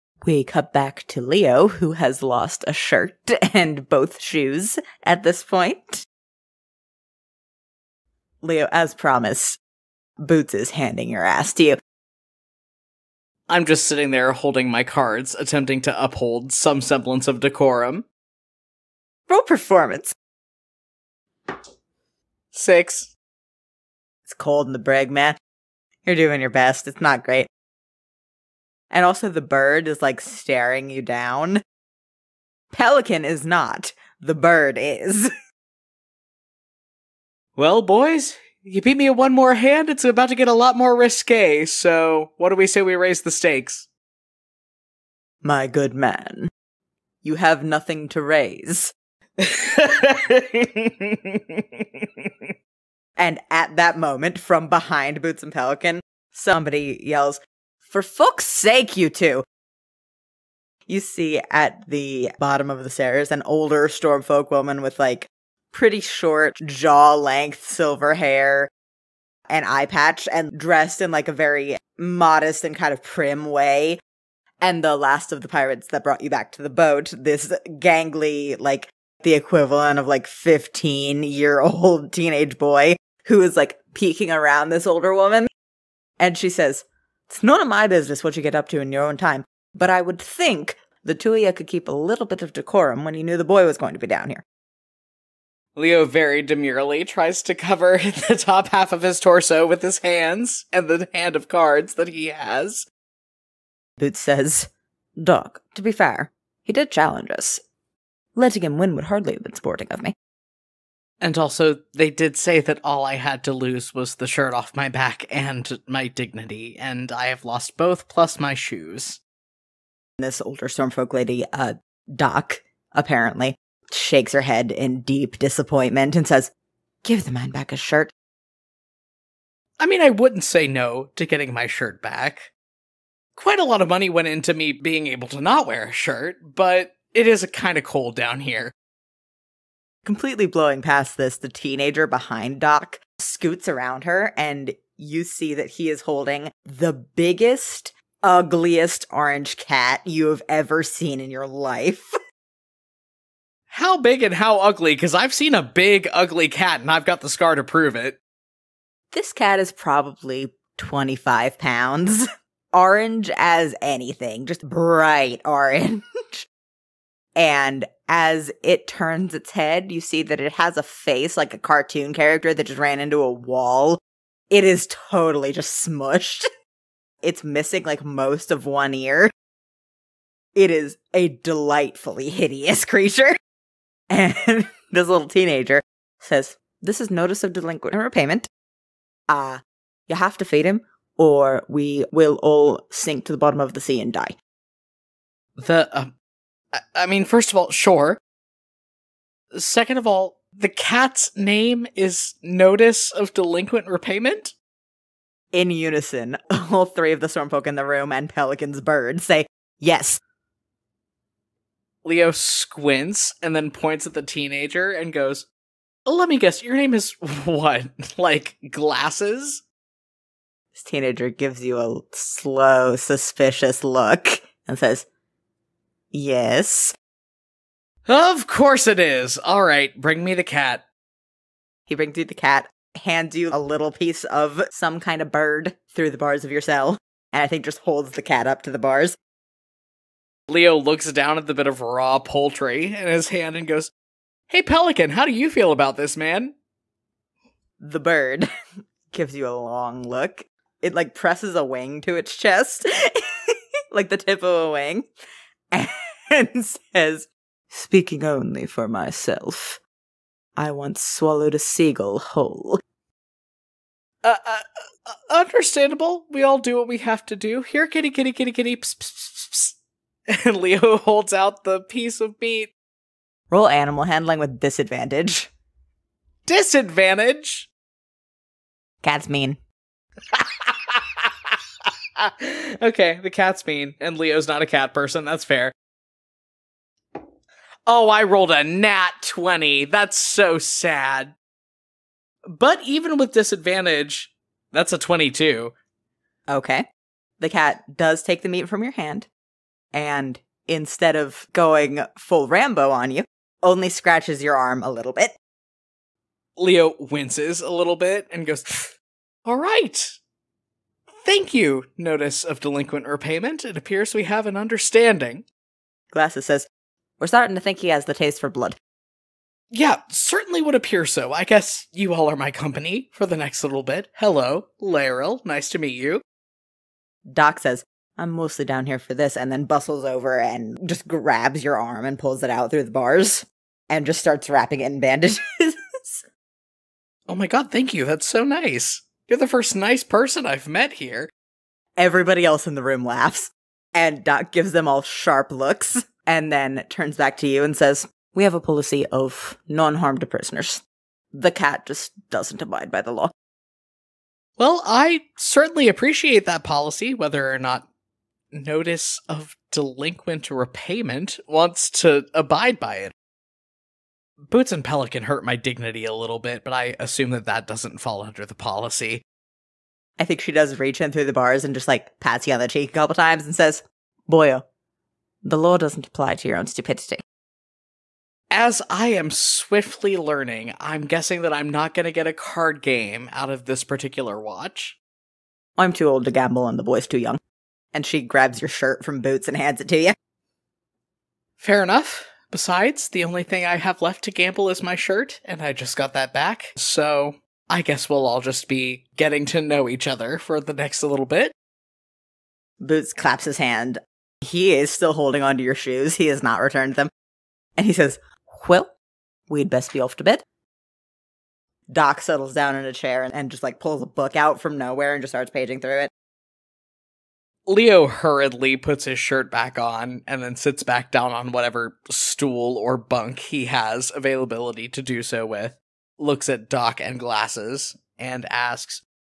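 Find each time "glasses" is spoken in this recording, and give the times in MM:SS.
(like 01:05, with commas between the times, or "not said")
03:38, 05:16, 07:07.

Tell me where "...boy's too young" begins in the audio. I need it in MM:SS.
06:26.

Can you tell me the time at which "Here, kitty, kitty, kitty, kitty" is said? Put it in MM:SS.
04:27.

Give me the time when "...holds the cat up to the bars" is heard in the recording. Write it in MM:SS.
03:57.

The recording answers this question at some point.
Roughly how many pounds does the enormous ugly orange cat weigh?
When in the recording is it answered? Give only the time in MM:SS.
02:40.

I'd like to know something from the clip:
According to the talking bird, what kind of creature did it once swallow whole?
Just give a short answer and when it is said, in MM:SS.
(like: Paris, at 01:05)
A seagull, at 04:21.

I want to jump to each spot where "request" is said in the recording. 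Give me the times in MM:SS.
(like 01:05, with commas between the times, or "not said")
not said.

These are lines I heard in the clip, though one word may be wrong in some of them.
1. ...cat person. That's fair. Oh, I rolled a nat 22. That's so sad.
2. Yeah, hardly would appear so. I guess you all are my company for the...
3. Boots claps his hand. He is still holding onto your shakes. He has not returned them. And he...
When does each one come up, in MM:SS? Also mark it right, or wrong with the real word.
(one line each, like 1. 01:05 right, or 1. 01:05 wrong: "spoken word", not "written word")
1. 04:44 wrong: "20", not "22"
2. 05:19 wrong: "certainly", not "hardly"
3. 06:42 wrong: "shoes", not "shakes".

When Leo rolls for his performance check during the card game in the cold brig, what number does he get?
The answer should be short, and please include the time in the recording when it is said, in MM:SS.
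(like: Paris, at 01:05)
6, at 00:22.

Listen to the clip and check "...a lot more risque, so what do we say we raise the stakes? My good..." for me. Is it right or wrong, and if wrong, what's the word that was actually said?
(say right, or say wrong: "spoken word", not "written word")
right.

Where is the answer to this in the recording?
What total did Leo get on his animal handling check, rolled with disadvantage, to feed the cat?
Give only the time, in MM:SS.
04:54.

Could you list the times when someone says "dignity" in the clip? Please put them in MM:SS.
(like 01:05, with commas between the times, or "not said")
01:56, 06:05.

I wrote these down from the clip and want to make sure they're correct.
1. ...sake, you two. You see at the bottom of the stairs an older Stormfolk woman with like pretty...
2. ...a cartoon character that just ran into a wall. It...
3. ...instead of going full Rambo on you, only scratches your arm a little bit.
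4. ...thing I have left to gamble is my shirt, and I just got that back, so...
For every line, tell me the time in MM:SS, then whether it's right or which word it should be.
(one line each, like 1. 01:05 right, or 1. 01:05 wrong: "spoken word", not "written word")
1. 00:58 right
2. 02:51 right
3. 05:00 right
4. 06:33 right.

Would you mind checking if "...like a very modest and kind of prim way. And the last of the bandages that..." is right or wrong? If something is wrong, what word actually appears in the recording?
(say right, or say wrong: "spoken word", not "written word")
wrong: "pirates", not "bandages".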